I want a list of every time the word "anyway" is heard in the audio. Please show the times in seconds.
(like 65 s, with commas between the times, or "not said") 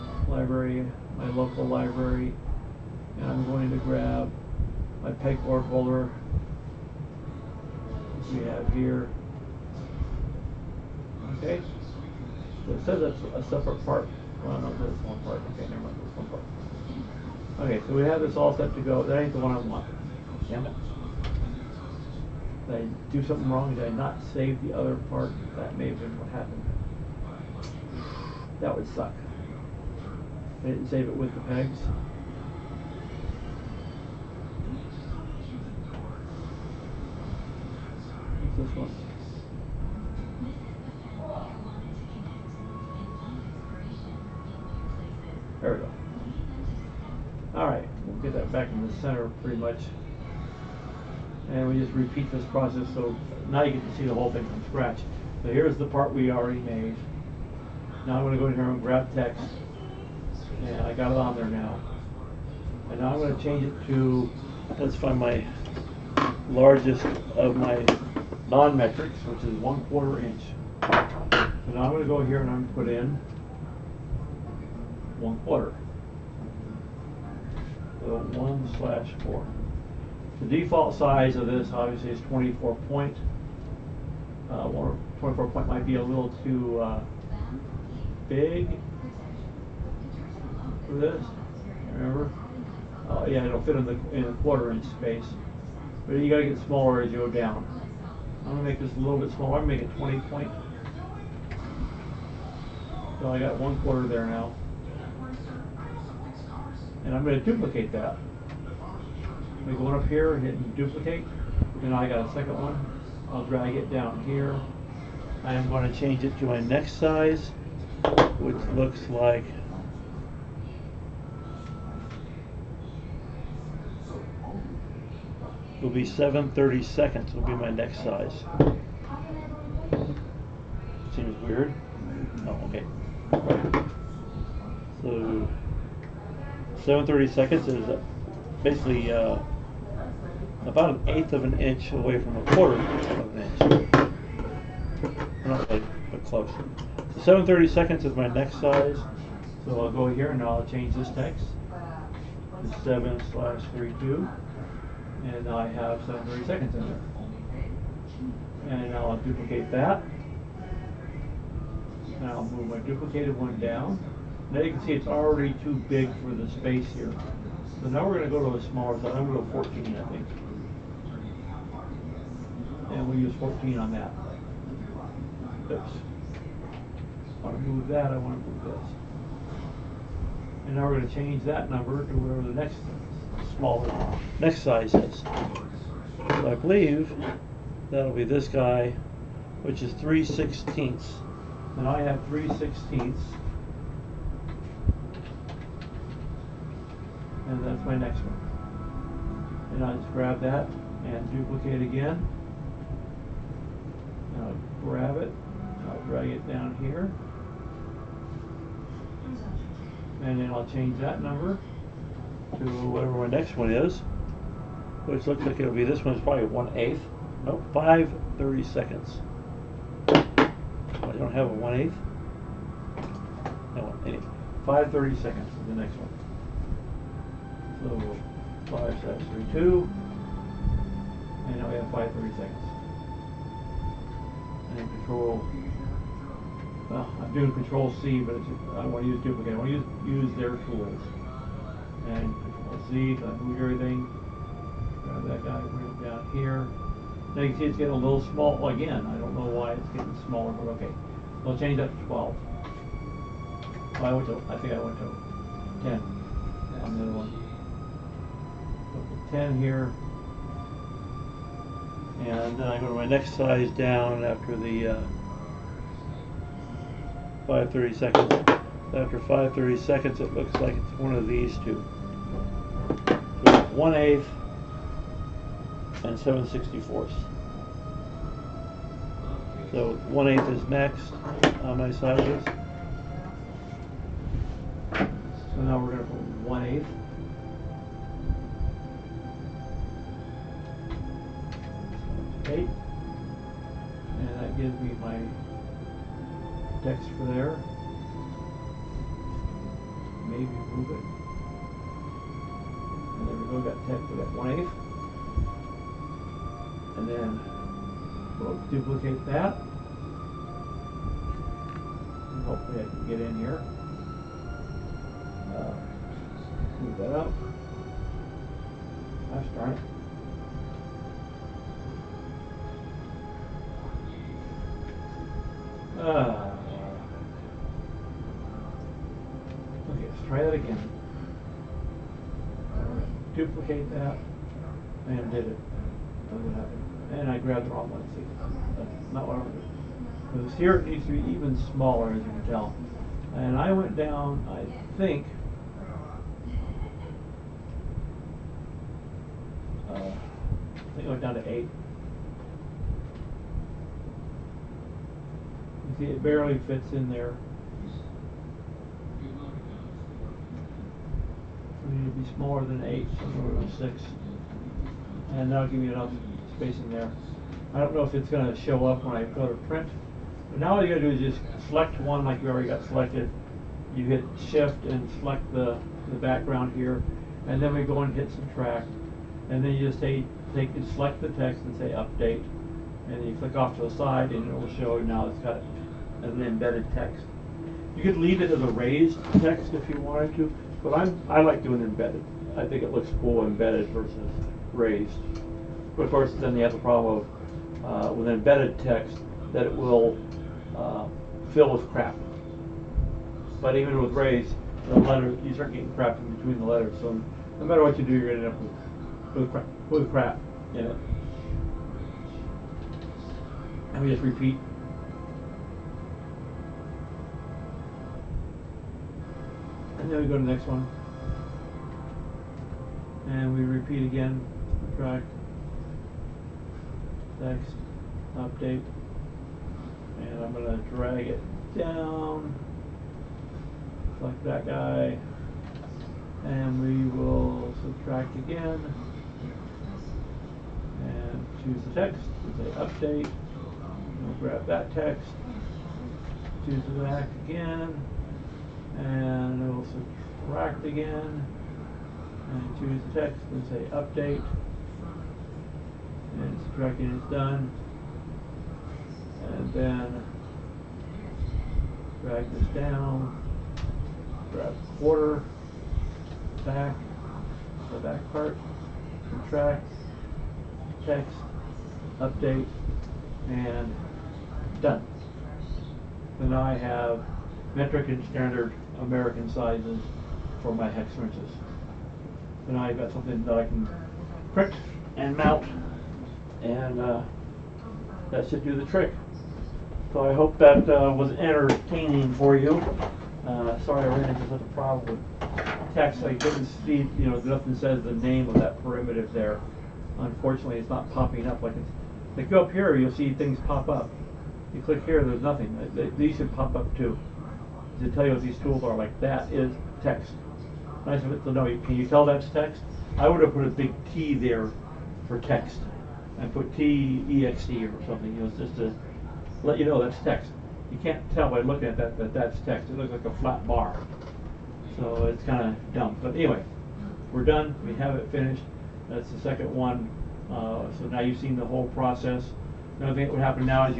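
224 s, 526 s.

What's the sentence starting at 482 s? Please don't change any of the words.
So now I've got something that I can print and mount, and uh, that should do the trick.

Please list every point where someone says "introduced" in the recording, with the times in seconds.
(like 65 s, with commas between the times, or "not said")
not said.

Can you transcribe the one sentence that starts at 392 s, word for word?
I think it looks cool embedded versus raised.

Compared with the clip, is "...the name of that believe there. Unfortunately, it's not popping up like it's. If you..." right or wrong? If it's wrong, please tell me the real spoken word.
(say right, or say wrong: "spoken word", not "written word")
wrong: "primitive", not "believe".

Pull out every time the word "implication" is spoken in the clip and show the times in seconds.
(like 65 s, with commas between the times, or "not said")
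not said.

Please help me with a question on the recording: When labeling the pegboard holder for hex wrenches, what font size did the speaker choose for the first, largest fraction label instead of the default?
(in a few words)
20 point.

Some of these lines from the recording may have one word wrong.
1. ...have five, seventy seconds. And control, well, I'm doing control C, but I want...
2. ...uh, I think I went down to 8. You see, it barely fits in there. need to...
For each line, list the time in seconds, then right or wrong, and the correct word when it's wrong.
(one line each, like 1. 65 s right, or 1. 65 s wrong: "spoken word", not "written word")
1. 231 s wrong: "thirty", not "seventy"
2. 349 s right.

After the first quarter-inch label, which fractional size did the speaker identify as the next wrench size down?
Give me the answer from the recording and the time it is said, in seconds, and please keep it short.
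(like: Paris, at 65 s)
7/32, at 152 s.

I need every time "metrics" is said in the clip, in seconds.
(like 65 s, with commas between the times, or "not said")
68 s, 477 s.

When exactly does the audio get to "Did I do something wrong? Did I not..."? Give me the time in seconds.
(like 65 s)
22 s.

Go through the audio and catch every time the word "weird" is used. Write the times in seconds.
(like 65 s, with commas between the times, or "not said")
131 s.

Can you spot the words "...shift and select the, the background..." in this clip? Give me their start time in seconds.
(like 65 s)
374 s.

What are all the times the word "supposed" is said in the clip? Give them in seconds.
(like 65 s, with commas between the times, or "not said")
not said.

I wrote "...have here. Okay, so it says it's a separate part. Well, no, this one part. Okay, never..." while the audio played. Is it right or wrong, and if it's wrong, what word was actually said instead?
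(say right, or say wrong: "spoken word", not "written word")
right.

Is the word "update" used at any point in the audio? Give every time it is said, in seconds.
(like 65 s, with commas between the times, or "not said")
381 s, 428 s, 442 s, 453 s, 472 s.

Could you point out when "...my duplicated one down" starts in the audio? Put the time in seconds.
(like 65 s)
162 s.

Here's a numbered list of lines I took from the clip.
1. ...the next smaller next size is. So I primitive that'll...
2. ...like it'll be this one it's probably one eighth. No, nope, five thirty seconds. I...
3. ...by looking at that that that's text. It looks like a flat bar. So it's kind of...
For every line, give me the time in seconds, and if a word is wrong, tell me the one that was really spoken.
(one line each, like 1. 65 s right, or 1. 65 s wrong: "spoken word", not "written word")
1. 182 s wrong: "believe", not "primitive"
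2. 215 s right
3. 521 s right.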